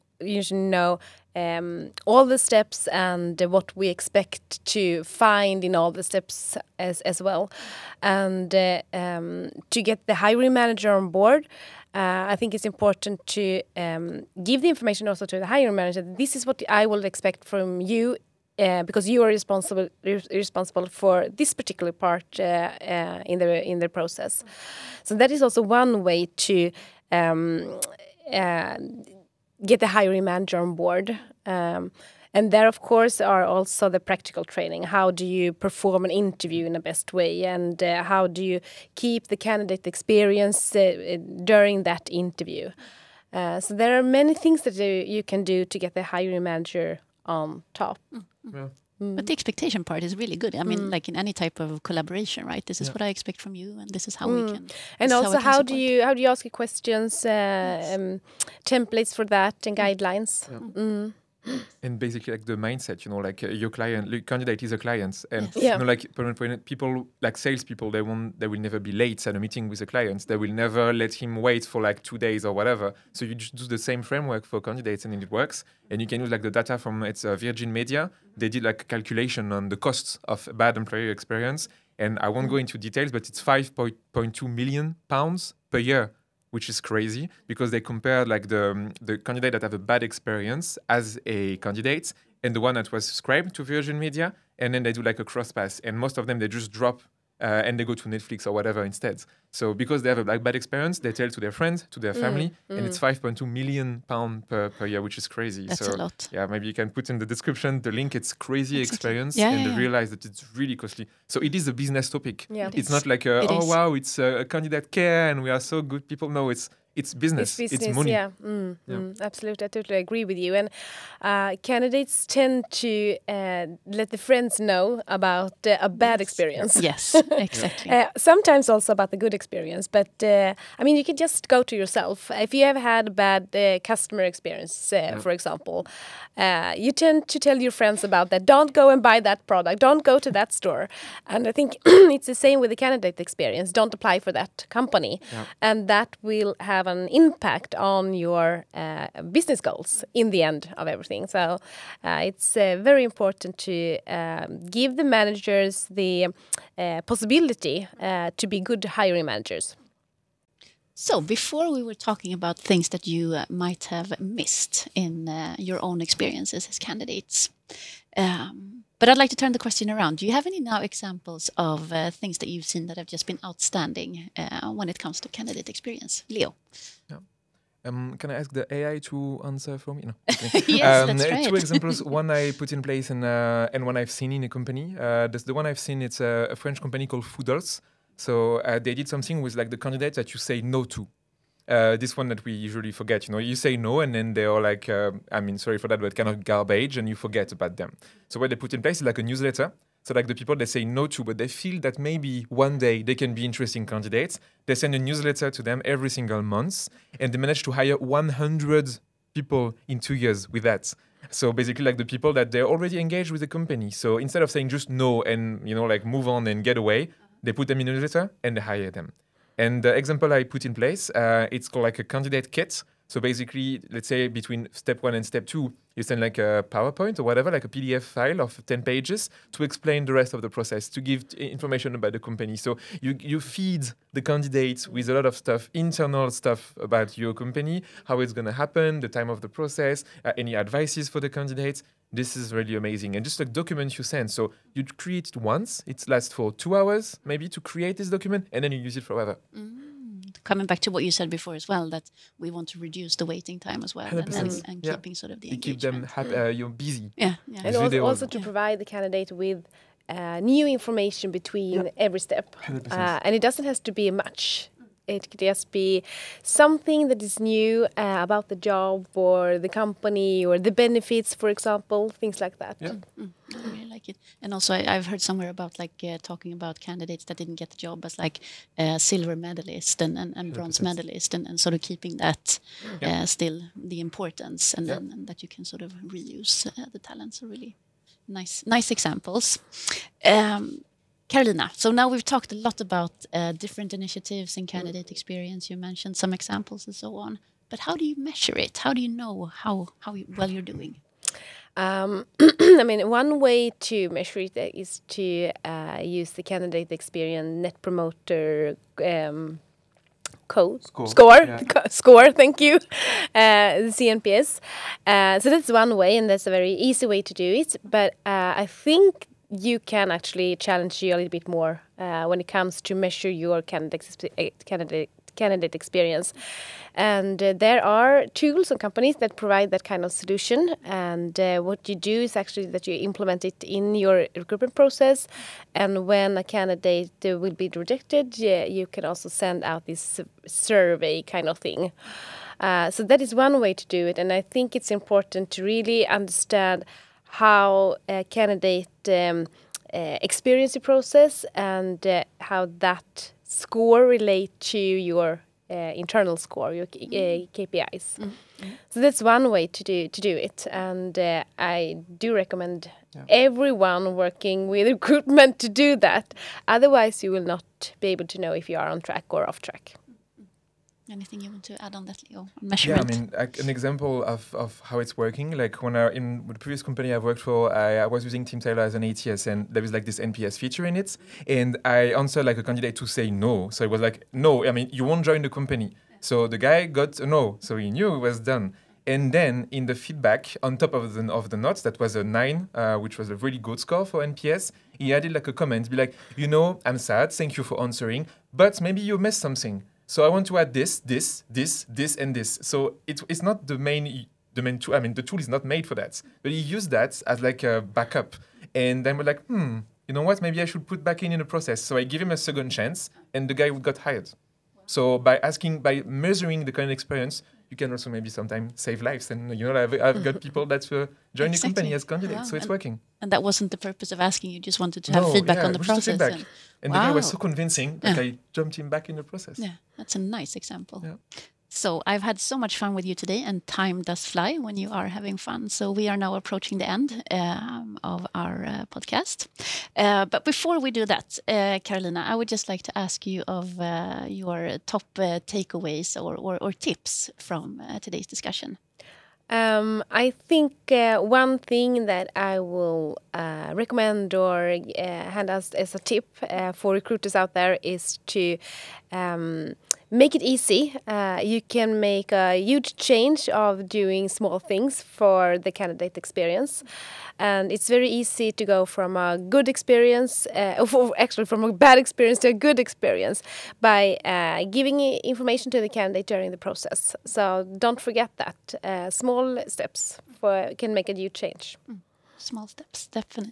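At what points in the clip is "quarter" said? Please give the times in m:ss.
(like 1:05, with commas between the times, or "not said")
not said.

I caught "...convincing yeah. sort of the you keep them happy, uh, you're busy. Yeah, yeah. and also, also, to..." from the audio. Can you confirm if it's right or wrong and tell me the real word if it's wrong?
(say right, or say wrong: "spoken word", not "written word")
wrong: "keeping", not "convincing".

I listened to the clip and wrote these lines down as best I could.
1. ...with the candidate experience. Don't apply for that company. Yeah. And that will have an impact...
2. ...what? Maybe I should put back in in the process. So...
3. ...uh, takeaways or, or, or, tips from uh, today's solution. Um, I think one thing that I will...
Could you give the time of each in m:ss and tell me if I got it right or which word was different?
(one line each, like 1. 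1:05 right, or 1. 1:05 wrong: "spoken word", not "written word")
1. 2:22 right
2. 6:50 right
3. 7:25 wrong: "discussion", not "solution".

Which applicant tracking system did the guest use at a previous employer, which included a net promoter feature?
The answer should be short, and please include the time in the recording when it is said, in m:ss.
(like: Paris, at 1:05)
Teamtailor, at 6:18.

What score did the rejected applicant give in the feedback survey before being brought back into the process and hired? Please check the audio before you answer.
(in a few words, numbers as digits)
9.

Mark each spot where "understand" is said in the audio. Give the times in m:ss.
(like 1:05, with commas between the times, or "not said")
5:46.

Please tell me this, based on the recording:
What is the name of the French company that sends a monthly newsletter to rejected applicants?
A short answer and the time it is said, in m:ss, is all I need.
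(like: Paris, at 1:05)
Foodles, at 3:07.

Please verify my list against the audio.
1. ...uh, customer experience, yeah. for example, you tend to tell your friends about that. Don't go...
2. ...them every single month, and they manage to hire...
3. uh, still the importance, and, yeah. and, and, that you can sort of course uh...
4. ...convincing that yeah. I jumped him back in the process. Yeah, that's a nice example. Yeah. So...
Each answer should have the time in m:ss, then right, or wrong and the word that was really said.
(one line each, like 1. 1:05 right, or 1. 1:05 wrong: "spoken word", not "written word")
1. 2:13 right
2. 3:25 right
3. 4:43 wrong: "reuse", not "course"
4. 7:07 right.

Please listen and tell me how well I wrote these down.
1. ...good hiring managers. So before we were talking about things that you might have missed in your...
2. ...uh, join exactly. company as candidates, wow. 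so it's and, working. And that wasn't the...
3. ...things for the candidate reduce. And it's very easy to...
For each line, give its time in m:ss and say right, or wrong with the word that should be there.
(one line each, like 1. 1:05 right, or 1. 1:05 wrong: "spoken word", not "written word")
1. 2:38 right
2. 7:00 right
3. 7:44 wrong: "experience", not "reduce".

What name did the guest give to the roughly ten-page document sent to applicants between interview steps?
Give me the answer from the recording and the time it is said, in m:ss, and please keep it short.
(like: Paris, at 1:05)
candidate kit, at 3:42.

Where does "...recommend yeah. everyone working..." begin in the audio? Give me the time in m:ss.
6:02.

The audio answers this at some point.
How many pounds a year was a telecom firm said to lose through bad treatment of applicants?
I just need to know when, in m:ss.
1:23.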